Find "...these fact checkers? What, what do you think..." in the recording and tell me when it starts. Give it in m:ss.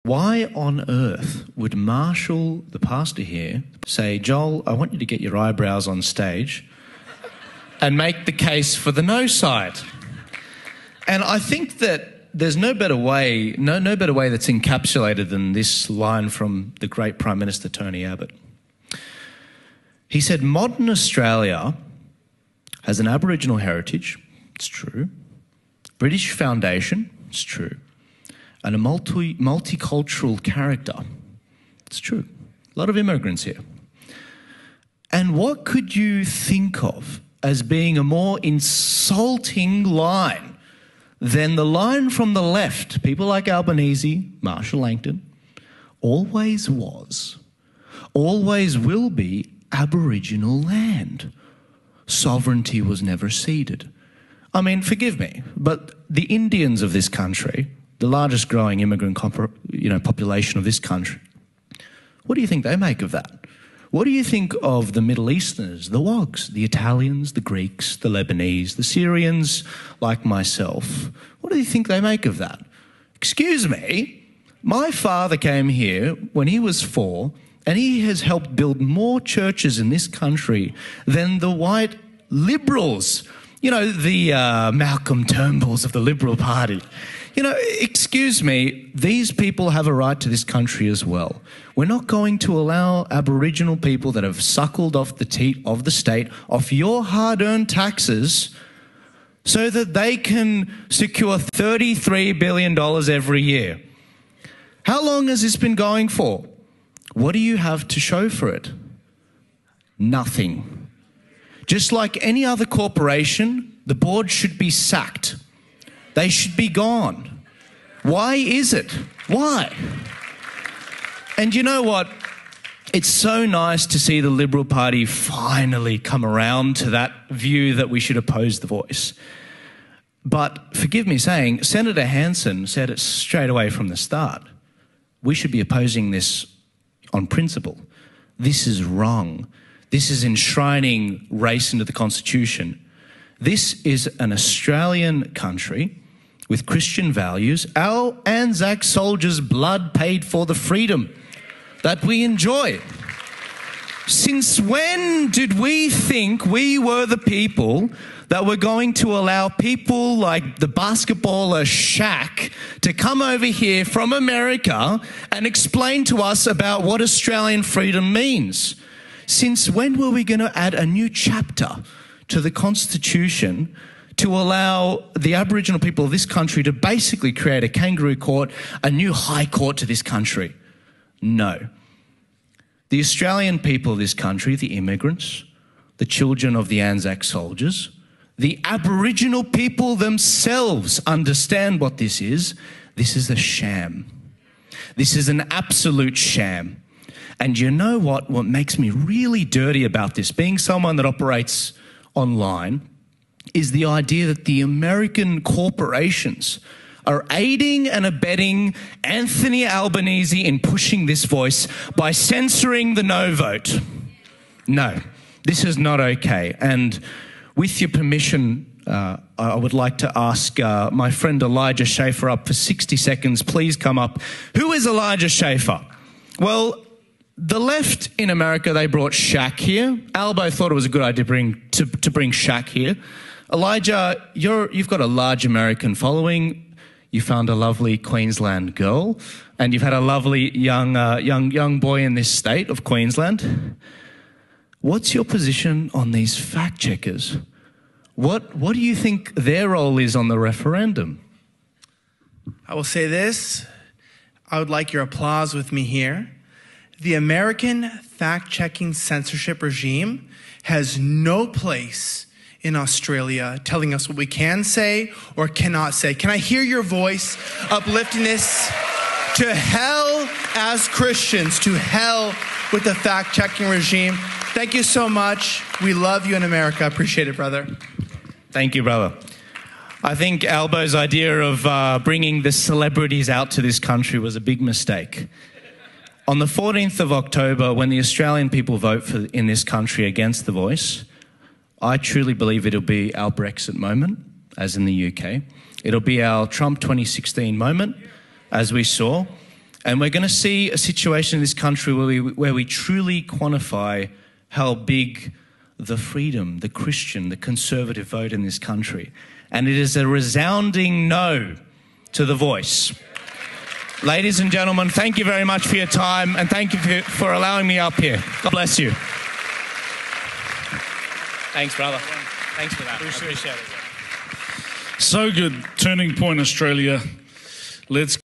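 4:06.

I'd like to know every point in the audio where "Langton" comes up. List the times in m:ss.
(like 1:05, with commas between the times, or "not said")
0:44.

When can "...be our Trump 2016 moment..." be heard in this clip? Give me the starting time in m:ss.
4:55.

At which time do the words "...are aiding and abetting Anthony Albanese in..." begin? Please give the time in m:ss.
3:27.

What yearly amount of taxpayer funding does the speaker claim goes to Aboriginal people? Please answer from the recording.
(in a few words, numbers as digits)
$33 billion.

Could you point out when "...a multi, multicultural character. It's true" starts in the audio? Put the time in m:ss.
0:28.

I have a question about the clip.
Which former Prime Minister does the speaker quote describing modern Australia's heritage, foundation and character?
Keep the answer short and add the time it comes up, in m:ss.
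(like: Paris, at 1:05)
Tony Abbott, at 0:17.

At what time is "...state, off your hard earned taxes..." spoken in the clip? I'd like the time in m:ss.
1:35.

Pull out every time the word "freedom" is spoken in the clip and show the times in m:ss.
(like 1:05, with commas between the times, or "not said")
2:30, 2:47, 5:05.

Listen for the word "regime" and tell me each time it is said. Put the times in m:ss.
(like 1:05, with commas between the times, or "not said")
4:19, 4:33.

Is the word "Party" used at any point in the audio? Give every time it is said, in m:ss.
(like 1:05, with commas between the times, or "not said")
1:26, 2:04.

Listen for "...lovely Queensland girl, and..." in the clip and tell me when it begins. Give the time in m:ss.
3:57.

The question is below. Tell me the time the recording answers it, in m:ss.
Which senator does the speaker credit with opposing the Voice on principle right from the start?
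2:11.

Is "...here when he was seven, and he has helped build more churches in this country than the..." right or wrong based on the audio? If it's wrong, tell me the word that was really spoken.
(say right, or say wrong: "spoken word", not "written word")
wrong: "four", not "seven".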